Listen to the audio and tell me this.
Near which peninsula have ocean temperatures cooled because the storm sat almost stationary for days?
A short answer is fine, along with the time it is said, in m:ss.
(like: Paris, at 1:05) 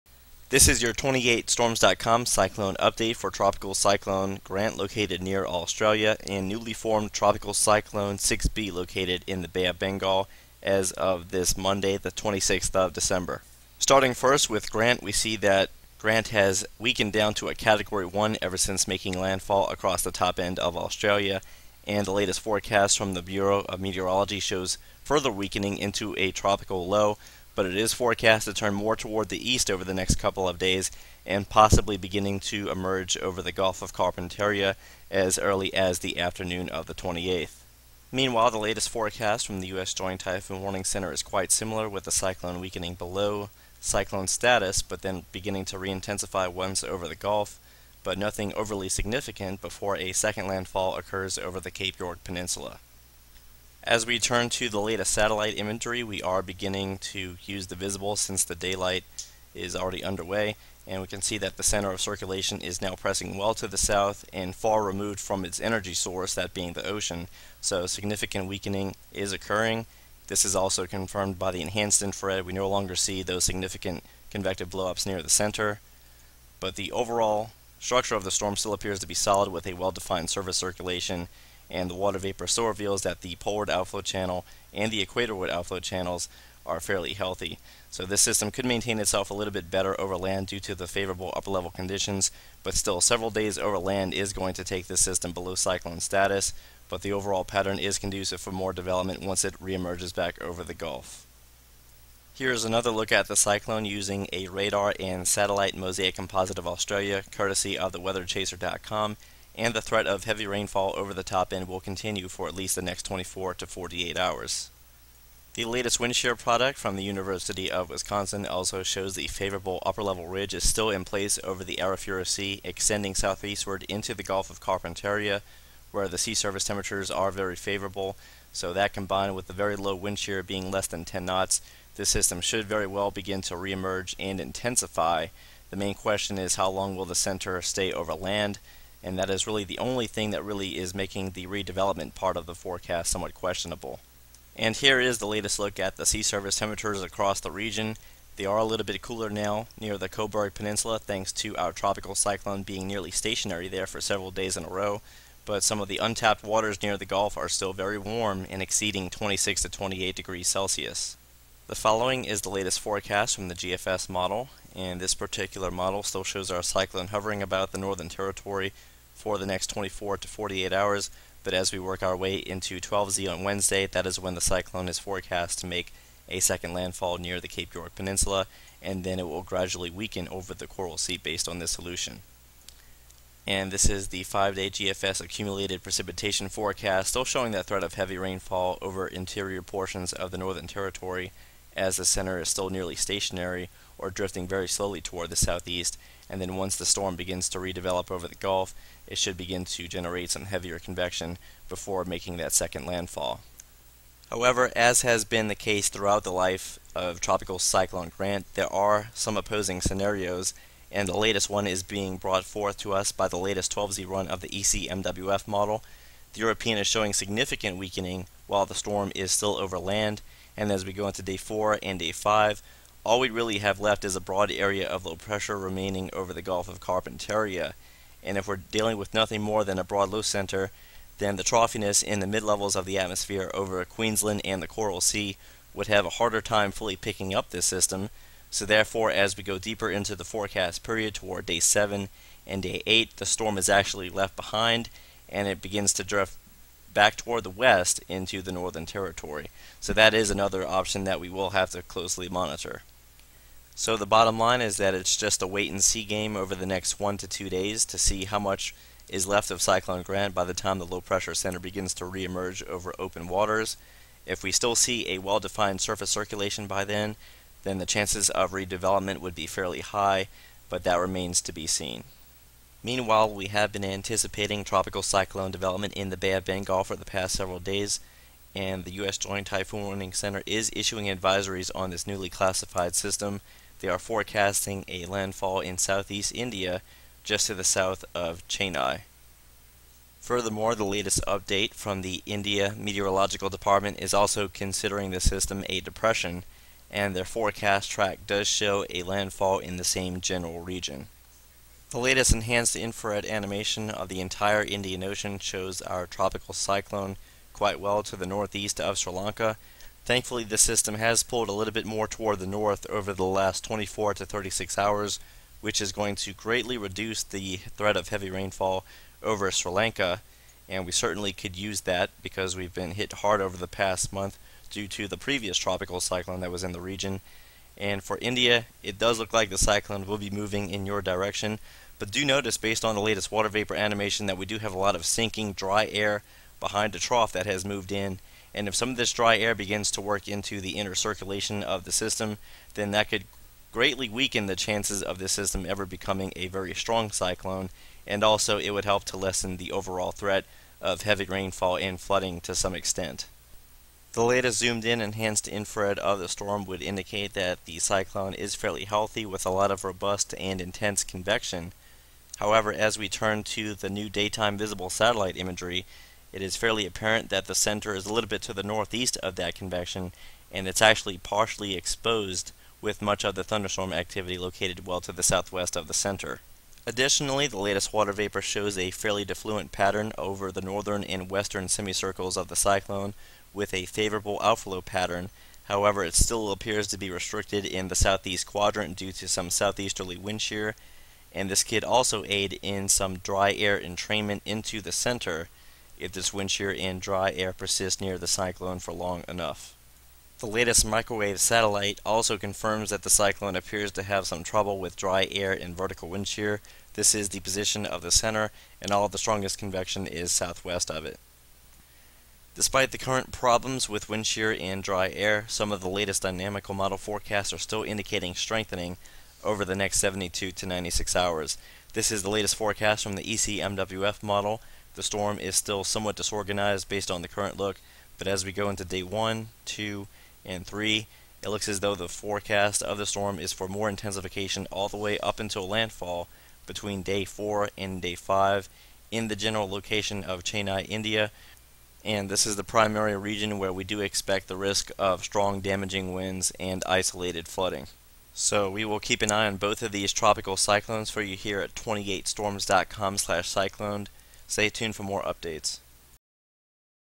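Cobourg Peninsula, at 2:30.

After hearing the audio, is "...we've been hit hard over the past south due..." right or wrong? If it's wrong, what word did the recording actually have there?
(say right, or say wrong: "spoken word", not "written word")
wrong: "month", not "south".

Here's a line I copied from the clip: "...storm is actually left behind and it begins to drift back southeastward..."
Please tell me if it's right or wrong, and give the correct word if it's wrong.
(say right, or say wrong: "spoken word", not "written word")
wrong: "toward", not "southeastward".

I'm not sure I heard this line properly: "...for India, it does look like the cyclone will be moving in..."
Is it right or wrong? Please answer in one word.
right.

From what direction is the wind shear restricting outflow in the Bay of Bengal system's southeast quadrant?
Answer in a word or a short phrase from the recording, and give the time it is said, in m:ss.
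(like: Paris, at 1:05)
southeasterly, at 6:29.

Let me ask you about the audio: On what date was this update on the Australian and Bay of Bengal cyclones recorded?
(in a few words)
Monday, 26 December.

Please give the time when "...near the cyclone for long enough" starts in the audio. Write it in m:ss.
6:38.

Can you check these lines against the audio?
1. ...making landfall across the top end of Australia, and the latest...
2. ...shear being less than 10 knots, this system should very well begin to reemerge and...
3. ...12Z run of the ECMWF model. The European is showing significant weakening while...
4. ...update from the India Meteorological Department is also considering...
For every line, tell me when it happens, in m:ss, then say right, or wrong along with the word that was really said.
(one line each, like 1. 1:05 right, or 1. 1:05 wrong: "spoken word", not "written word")
1. 0:18 right
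2. 2:10 right
3. 3:33 right
4. 4:51 right.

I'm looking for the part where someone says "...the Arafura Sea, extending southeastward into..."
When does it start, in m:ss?
2:01.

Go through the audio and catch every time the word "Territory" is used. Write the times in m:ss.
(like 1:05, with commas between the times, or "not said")
2:48, 3:10, 4:08.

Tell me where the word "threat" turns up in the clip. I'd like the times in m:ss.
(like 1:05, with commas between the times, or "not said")
1:49, 3:07, 5:17, 5:50.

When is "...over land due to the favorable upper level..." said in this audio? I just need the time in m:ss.
1:29.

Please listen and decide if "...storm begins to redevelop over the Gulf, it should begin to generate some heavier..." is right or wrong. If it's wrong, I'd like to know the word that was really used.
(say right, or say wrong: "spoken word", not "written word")
right.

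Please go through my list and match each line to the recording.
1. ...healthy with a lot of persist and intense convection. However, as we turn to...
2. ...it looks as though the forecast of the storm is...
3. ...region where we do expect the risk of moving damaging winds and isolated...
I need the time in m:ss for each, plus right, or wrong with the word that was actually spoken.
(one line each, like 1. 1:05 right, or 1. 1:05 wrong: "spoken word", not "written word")
1. 5:58 wrong: "robust", not "persist"
2. 7:11 right
3. 7:23 wrong: "strong", not "moving".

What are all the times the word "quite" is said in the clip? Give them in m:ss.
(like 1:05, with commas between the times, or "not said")
0:41, 5:07.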